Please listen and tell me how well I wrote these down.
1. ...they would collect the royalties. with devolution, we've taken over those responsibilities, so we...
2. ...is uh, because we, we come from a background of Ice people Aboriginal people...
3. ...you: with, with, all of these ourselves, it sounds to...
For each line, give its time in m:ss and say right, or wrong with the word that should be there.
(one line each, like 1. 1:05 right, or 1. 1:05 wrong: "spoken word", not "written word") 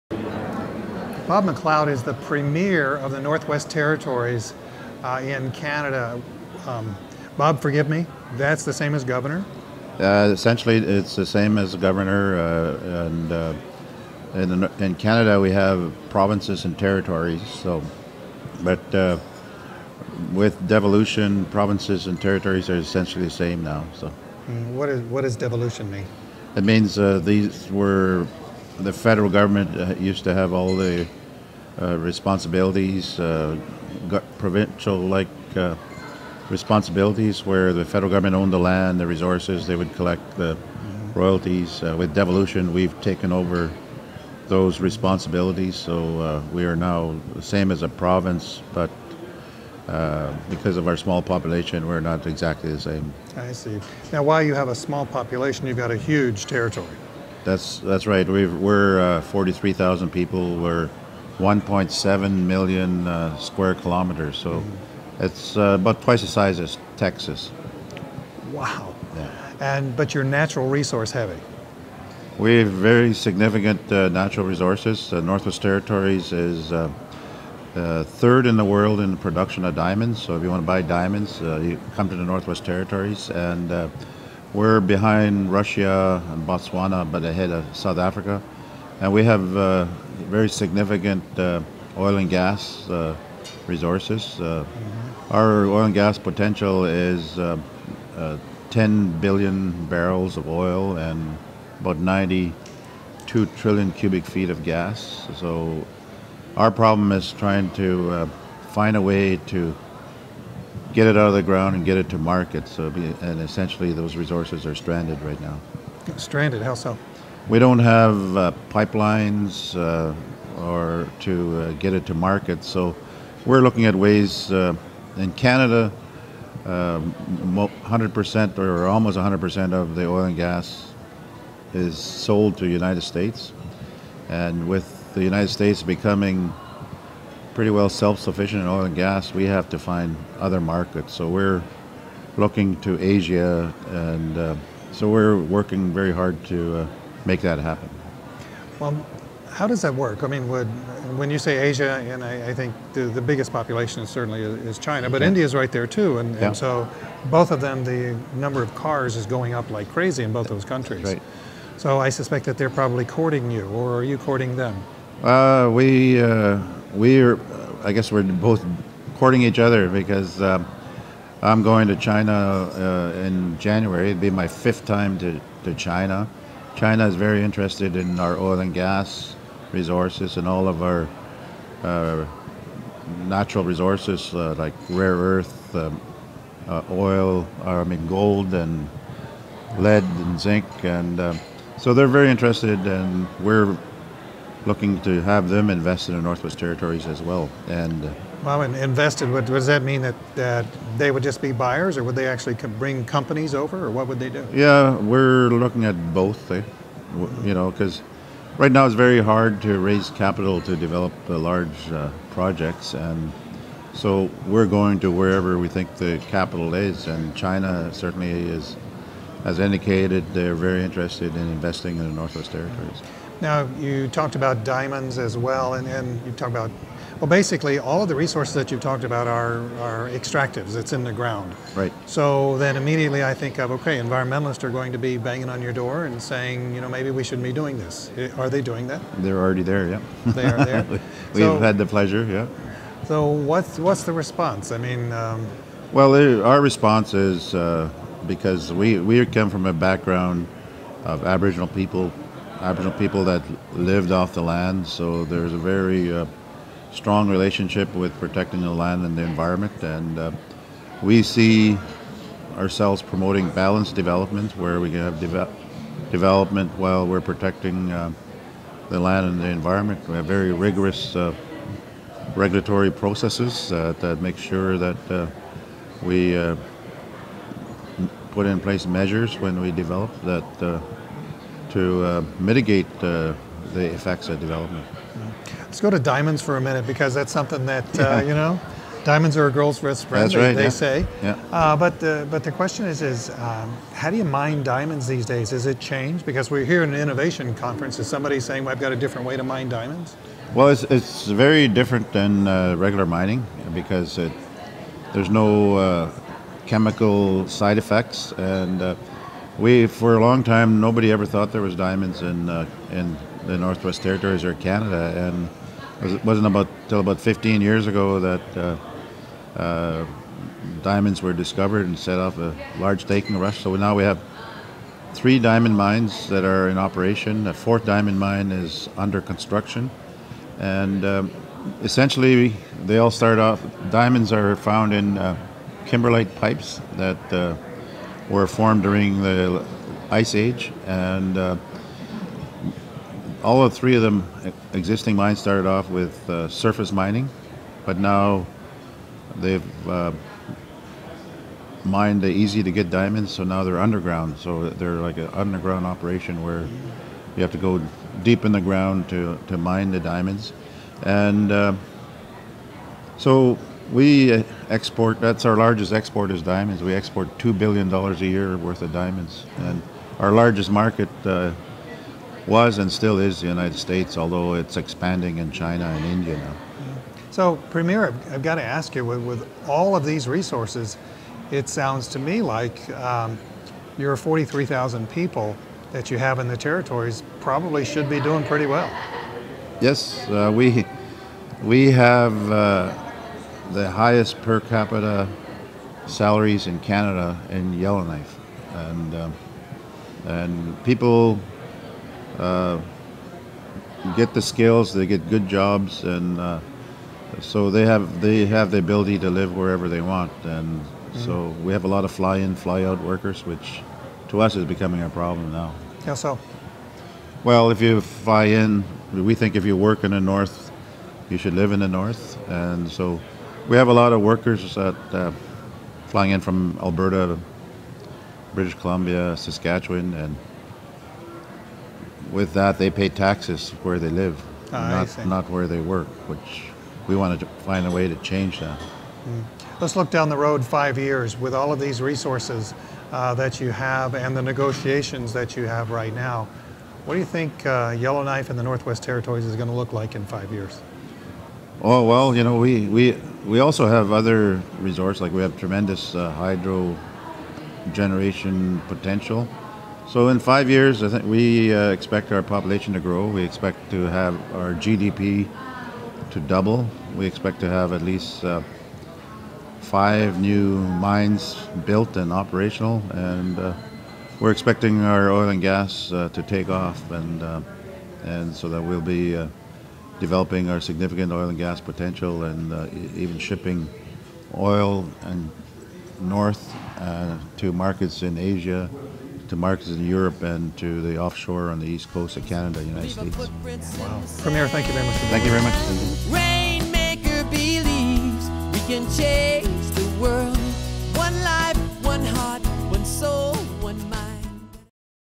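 1. 0:39 right
2. 4:07 wrong: "Aboriginal", not "Ice"
3. 6:18 wrong: "resources", not "ourselves".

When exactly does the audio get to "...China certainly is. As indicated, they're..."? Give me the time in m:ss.
3:37.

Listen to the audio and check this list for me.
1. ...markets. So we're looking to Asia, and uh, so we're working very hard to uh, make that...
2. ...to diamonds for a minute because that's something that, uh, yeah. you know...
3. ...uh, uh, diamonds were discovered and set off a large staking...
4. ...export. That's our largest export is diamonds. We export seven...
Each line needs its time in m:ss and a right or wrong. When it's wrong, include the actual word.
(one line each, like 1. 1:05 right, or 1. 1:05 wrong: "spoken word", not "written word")
1. 2:20 right
2. 4:45 right
3. 5:18 right
4. 6:04 wrong: "two", not "seven".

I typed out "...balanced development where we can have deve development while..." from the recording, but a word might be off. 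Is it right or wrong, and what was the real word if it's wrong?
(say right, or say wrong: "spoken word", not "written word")
right.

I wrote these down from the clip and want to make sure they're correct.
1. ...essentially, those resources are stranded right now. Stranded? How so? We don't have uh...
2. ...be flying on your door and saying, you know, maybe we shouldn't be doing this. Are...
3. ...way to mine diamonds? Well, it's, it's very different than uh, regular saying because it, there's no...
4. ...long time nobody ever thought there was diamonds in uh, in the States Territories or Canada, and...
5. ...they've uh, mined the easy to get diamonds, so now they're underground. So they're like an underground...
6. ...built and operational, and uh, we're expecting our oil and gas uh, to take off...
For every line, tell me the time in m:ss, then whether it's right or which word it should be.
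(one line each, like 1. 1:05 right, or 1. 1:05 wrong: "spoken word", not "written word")
1. 1:53 right
2. 3:54 wrong: "banging", not "flying"
3. 4:59 wrong: "mining", not "saying"
4. 5:10 wrong: "Northwest", not "States"
5. 5:49 right
6. 7:51 right.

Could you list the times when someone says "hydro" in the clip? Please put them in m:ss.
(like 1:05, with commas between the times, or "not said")
7:36.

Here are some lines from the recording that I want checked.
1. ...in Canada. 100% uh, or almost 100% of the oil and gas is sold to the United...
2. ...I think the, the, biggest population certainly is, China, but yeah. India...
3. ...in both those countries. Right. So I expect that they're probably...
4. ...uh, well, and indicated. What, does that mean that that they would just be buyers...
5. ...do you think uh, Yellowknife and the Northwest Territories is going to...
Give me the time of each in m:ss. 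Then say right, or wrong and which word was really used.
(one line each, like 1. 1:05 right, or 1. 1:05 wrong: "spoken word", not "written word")
1. 2:05 right
2. 2:32 right
3. 2:40 wrong: "suspect", not "expect"
4. 3:18 wrong: "invested", not "indicated"
5. 7:27 right.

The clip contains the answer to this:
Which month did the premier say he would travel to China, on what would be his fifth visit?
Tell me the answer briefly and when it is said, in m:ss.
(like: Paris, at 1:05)
January, at 2:53.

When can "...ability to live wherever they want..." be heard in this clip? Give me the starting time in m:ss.
6:48.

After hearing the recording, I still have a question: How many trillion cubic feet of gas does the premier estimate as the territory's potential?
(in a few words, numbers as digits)
92.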